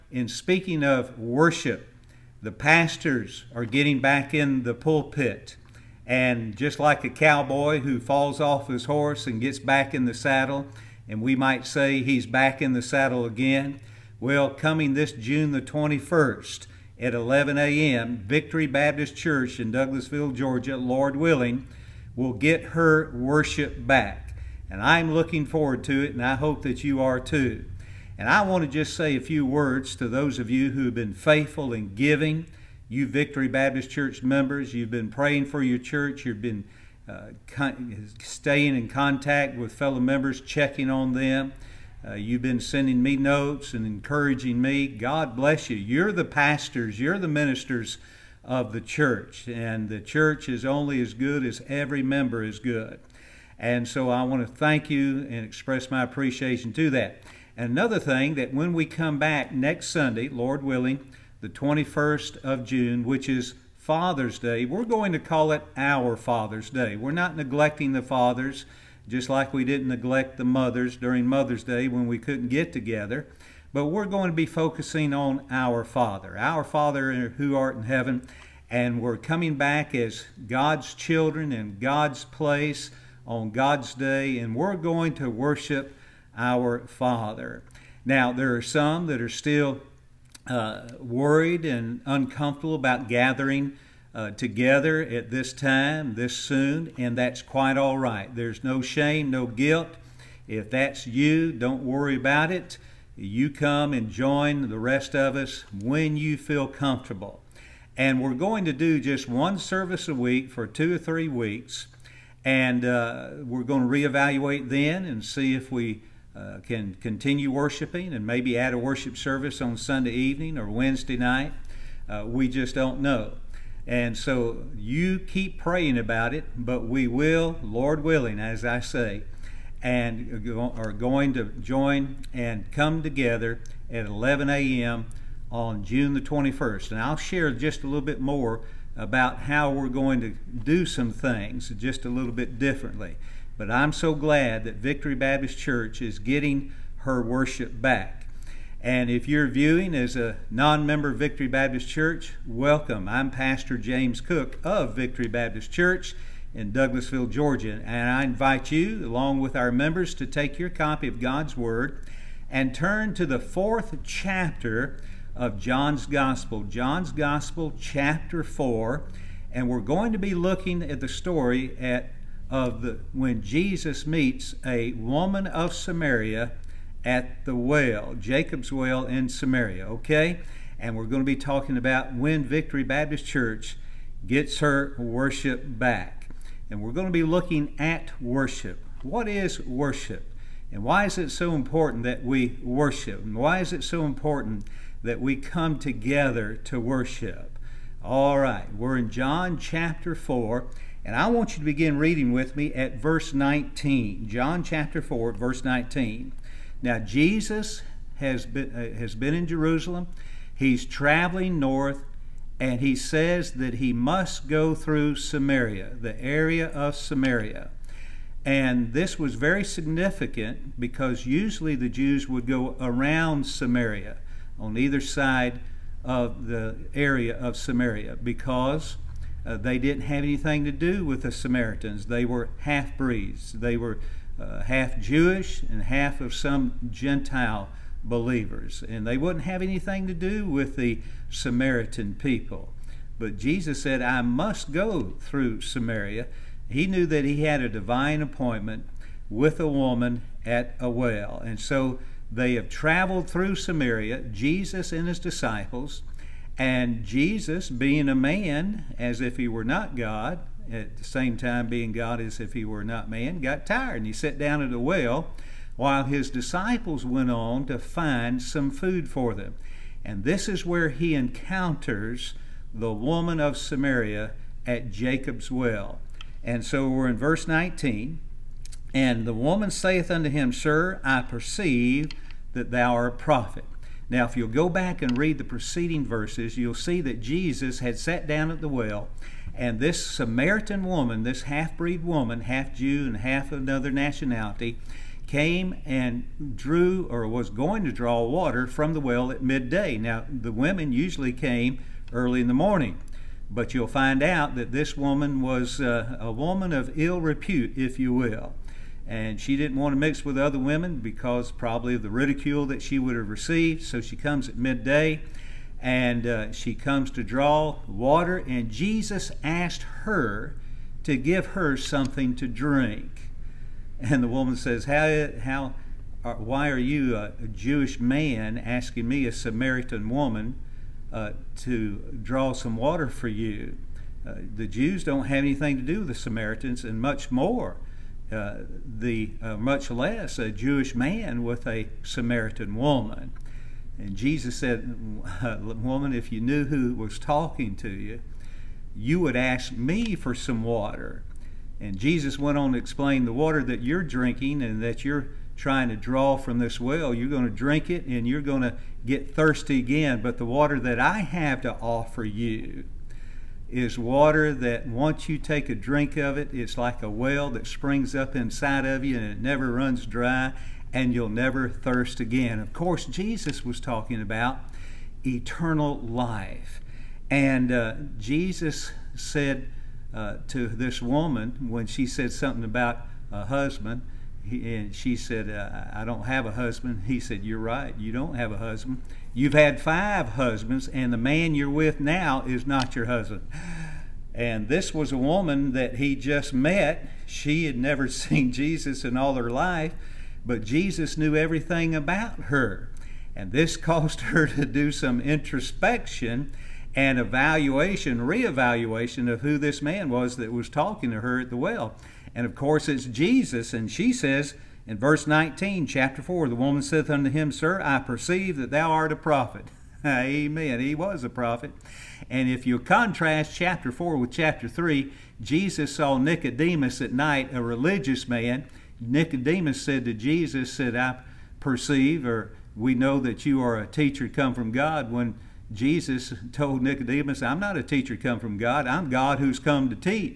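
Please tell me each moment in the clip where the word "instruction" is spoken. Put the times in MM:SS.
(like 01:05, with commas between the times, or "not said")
not said.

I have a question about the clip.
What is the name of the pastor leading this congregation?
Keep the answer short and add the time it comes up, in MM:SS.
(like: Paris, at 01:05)
James Cook, at 02:33.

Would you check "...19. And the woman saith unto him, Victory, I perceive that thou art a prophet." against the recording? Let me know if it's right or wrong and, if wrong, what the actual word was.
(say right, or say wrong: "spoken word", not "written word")
wrong: "Sir", not "Victory".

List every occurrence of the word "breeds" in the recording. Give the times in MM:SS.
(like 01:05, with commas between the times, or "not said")
03:52, 04:51.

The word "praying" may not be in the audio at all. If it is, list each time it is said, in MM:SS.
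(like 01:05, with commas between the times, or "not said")
00:35, 02:05.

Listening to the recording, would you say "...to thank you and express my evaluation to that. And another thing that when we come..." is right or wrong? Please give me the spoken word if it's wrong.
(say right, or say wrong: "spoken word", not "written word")
wrong: "appreciation", not "evaluation".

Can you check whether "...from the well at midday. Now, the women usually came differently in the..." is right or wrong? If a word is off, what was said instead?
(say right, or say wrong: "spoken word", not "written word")
wrong: "early", not "differently".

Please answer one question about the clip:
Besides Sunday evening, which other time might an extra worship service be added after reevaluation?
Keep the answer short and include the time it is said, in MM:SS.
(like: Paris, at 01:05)
Wednesday night, at 02:00.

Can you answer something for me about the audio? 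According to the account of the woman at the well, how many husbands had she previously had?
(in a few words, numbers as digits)
5.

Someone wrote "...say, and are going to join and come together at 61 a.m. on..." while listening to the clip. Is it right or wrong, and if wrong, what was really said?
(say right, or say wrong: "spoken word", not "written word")
wrong: "11", not "61".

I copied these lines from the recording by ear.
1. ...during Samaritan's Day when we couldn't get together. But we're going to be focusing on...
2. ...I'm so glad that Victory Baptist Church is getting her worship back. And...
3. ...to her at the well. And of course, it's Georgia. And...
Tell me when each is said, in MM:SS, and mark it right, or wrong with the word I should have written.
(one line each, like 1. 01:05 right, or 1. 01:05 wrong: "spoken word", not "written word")
1. 01:10 wrong: "Mother", not "Samaritan"
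2. 02:23 right
3. 06:51 wrong: "Jesus", not "Georgia".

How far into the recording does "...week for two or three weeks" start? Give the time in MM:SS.
01:50.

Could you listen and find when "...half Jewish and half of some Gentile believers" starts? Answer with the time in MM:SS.
03:54.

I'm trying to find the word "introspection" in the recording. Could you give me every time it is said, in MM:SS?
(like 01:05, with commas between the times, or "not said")
06:45.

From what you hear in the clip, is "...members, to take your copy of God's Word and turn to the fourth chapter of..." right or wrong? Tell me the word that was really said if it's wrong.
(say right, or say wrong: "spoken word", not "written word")
right.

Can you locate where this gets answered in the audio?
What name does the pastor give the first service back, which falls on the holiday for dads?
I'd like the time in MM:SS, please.
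01:05.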